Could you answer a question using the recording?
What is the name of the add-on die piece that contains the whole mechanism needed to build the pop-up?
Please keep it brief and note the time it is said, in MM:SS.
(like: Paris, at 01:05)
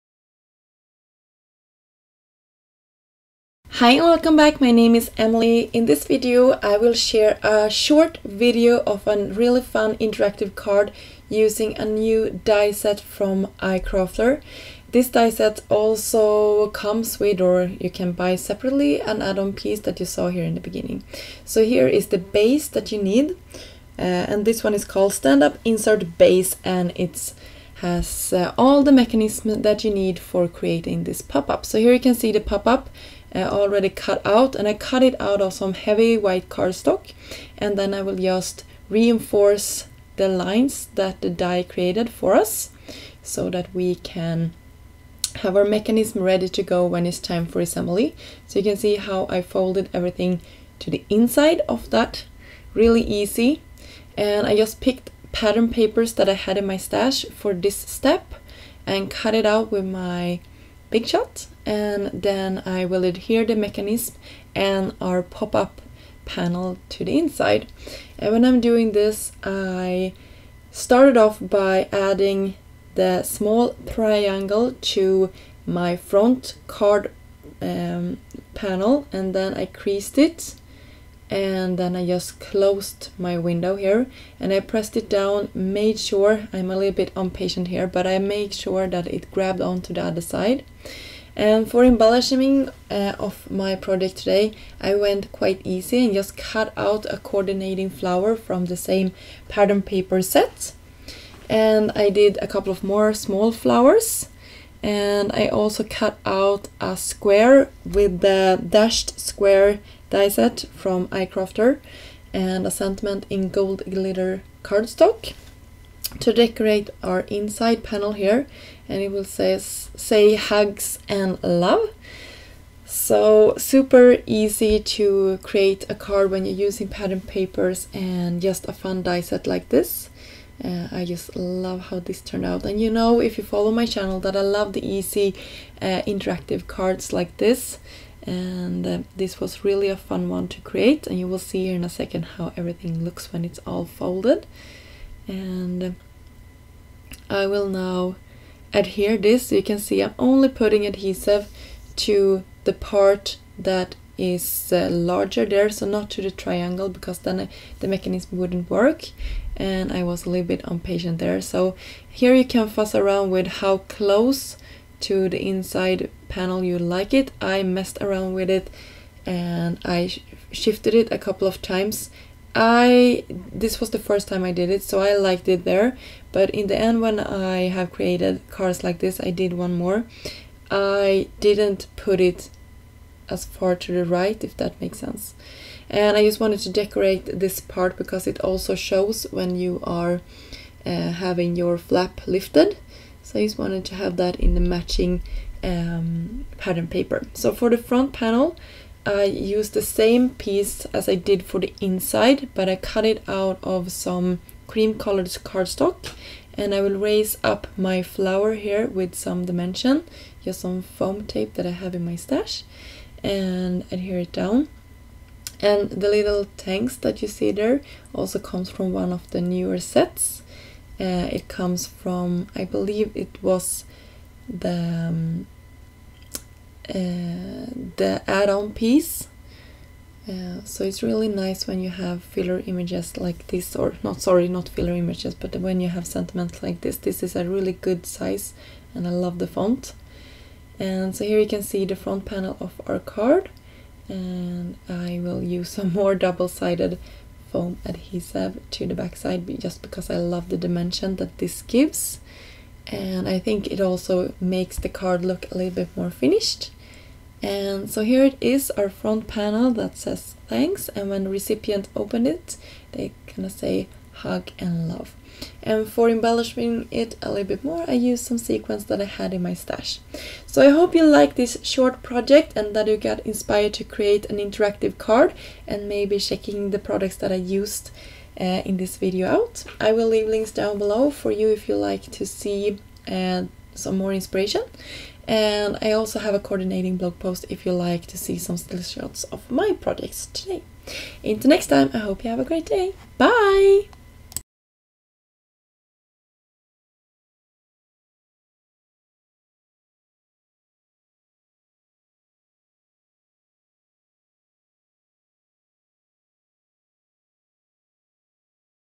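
Stand Up Insert Base, at 00:25.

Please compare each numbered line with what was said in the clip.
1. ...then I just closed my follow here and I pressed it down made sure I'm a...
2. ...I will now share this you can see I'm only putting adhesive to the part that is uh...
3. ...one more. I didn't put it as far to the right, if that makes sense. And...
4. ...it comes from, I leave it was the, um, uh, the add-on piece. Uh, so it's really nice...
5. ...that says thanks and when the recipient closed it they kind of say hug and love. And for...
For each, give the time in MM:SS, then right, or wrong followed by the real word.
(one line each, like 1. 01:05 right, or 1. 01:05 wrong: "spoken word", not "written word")
1. 01:21 wrong: "window", not "follow"
2. 02:27 wrong: "adhere", not "share"
3. 02:59 right
4. 03:41 wrong: "believe", not "leave"
5. 04:19 wrong: "opened", not "closed".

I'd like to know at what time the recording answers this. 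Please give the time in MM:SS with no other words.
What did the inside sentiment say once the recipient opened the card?
02:00.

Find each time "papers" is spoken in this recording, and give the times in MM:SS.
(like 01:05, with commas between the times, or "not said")
00:55, 01:39, 02:07, 03:16.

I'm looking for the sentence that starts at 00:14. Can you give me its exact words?
This die set also comes with or you can buy separately an add-on piece that you saw here in the beginning.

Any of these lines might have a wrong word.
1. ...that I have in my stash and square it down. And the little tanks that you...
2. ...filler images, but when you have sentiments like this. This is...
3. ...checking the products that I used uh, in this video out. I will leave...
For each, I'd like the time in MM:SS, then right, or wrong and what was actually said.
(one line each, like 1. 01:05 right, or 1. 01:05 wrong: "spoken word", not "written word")
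1. 03:31 wrong: "adhere", not "square"
2. 03:54 right
3. 04:36 right.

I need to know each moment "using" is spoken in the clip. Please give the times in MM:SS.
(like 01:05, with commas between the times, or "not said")
00:11, 02:06.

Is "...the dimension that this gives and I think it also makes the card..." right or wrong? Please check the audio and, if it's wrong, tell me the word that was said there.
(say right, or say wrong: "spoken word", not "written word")
right.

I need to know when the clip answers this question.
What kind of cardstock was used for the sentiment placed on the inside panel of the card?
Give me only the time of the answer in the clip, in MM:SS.
01:53.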